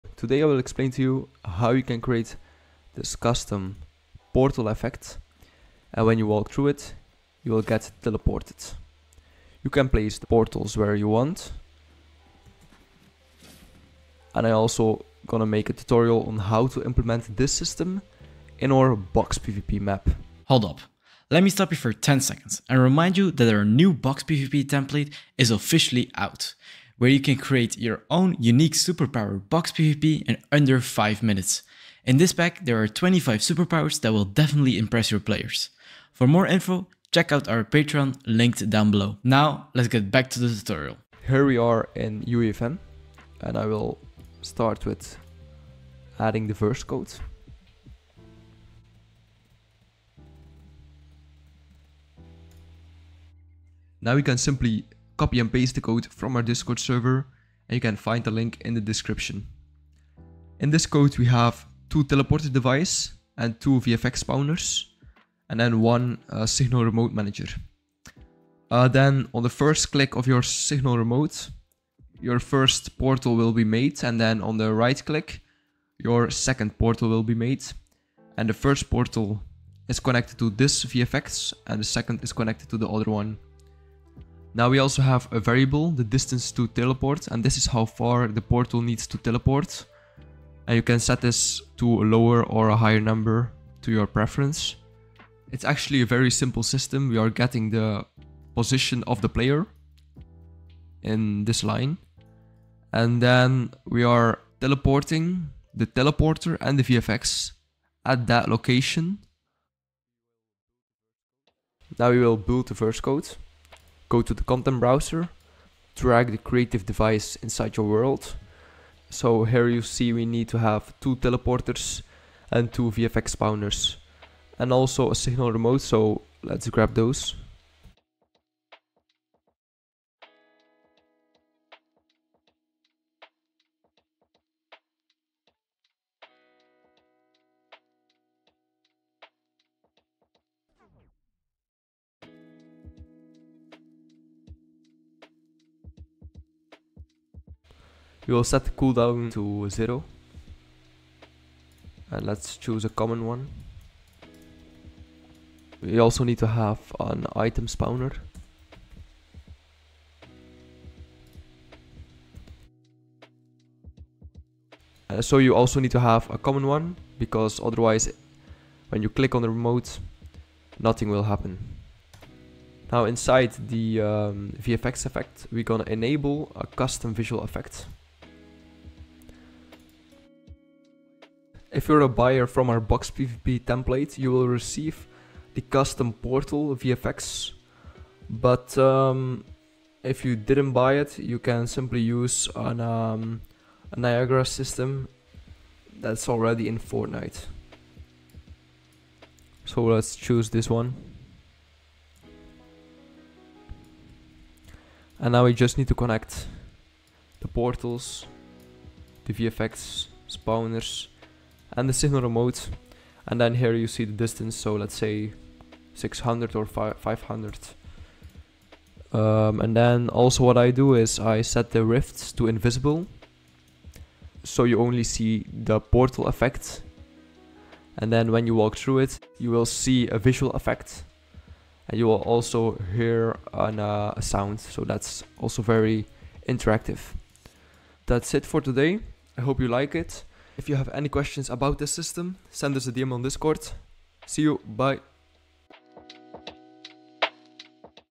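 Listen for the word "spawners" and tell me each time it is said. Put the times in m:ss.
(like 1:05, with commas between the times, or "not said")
1:04, 2:03, 2:37, 3:30.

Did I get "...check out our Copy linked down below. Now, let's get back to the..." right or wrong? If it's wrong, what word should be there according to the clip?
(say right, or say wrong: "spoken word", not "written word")
wrong: "Patreon", not "Copy".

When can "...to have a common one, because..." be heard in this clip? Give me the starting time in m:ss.
2:45.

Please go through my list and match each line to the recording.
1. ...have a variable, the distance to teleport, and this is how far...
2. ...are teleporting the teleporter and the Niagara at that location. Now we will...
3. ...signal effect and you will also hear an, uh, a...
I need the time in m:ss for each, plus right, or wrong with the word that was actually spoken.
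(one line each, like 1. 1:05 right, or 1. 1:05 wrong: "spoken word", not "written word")
1. 1:25 right
2. 1:44 wrong: "VFX", not "Niagara"
3. 3:50 wrong: "visual", not "signal".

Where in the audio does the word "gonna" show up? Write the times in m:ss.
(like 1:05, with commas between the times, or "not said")
0:15, 2:55.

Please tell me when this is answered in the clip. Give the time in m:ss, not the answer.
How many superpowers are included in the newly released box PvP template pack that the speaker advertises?
0:32.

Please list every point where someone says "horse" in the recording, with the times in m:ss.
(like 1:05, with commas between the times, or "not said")
not said.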